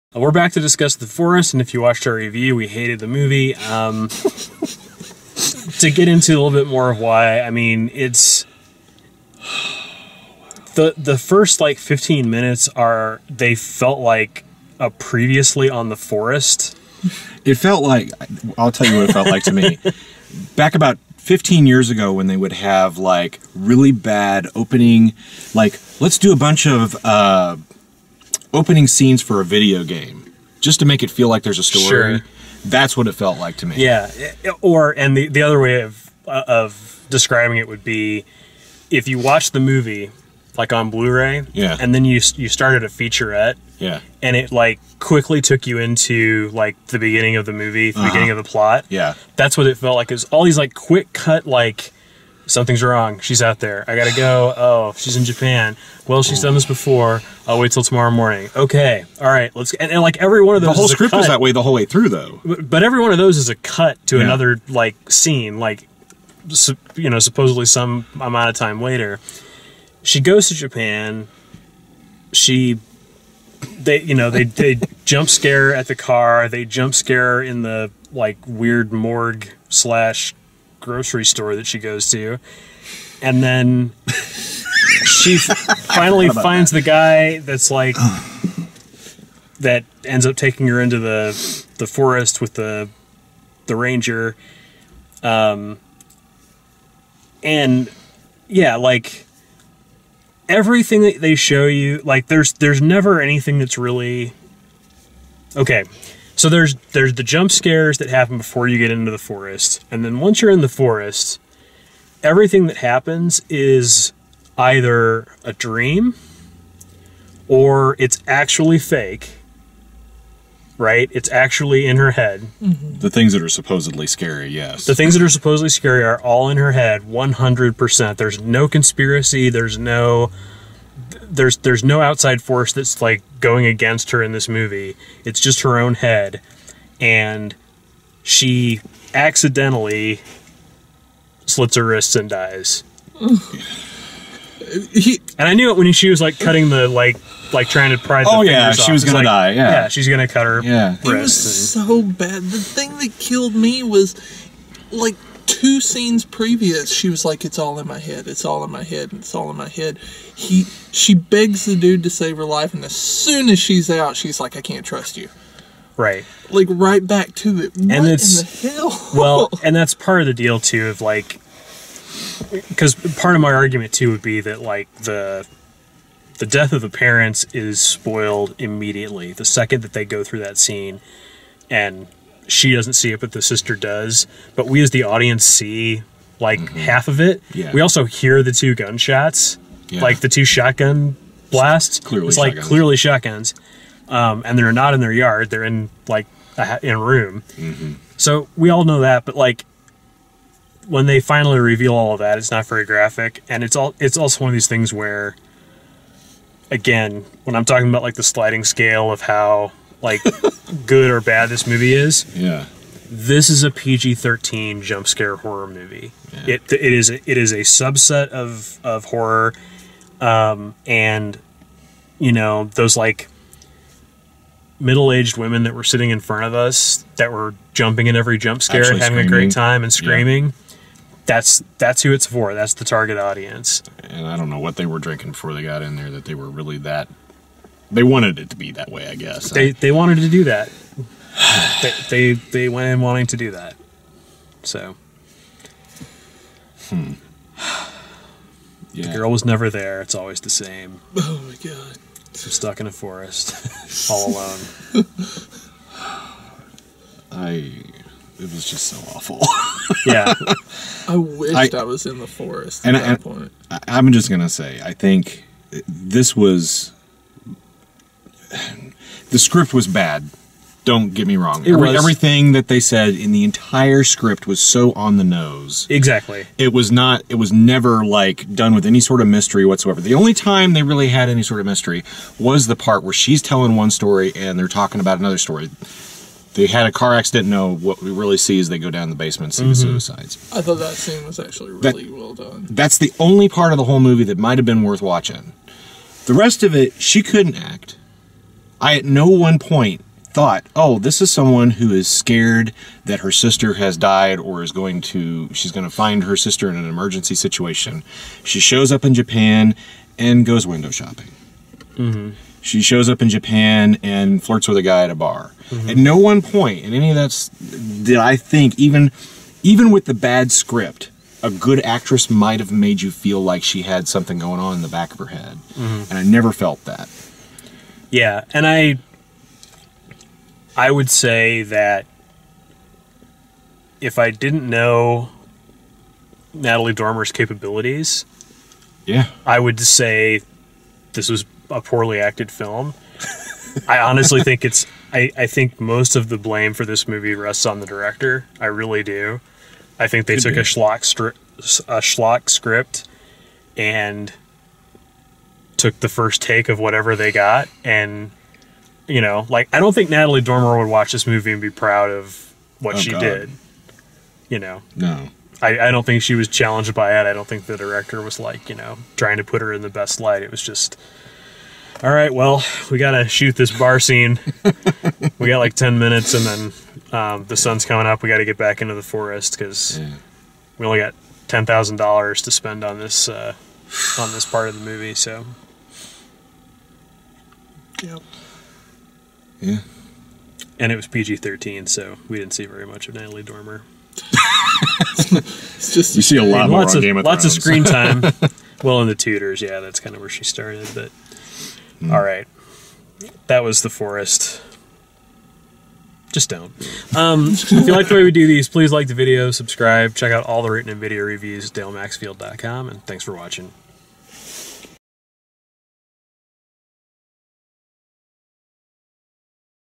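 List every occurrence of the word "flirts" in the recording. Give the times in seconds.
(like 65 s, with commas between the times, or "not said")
314 s.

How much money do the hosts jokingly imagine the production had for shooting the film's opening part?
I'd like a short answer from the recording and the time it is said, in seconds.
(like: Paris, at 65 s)
$10000, at 381 s.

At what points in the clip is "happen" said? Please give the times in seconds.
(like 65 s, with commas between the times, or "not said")
108 s, 112 s.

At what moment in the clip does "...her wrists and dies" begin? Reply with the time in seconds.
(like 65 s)
141 s.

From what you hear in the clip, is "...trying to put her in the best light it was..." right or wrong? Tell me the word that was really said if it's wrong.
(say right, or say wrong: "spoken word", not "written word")
right.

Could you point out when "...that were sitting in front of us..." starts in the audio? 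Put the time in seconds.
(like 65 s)
225 s.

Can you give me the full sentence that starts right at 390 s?
And it was PG 13, so we didn't see very much of Natalie Dormer.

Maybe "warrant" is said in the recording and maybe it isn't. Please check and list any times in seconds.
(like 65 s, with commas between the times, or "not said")
not said.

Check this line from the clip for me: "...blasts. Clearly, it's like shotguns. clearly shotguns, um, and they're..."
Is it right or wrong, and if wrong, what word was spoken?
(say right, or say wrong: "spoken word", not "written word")
right.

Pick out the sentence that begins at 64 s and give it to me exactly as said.
another like scene, like you know, supposedly some amount of time later.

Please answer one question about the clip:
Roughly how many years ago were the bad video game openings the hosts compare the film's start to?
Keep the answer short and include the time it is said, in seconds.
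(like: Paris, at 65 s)
15, at 21 s.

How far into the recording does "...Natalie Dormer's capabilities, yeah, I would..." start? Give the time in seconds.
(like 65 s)
336 s.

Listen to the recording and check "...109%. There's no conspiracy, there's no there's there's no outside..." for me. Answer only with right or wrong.
wrong.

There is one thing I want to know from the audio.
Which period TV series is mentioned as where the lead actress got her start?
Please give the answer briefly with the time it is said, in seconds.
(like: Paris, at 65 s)
The Tudors, at 399 s.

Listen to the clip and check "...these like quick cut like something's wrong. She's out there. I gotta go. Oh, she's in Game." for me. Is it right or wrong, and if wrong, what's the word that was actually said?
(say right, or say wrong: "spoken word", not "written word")
wrong: "Japan", not "Game".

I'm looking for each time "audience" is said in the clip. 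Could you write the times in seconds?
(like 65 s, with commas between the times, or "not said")
185 s, 233 s.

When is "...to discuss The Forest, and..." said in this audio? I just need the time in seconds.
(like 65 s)
0 s.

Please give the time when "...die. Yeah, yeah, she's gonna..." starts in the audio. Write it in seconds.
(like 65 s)
149 s.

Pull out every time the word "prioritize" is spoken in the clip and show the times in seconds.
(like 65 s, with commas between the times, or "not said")
not said.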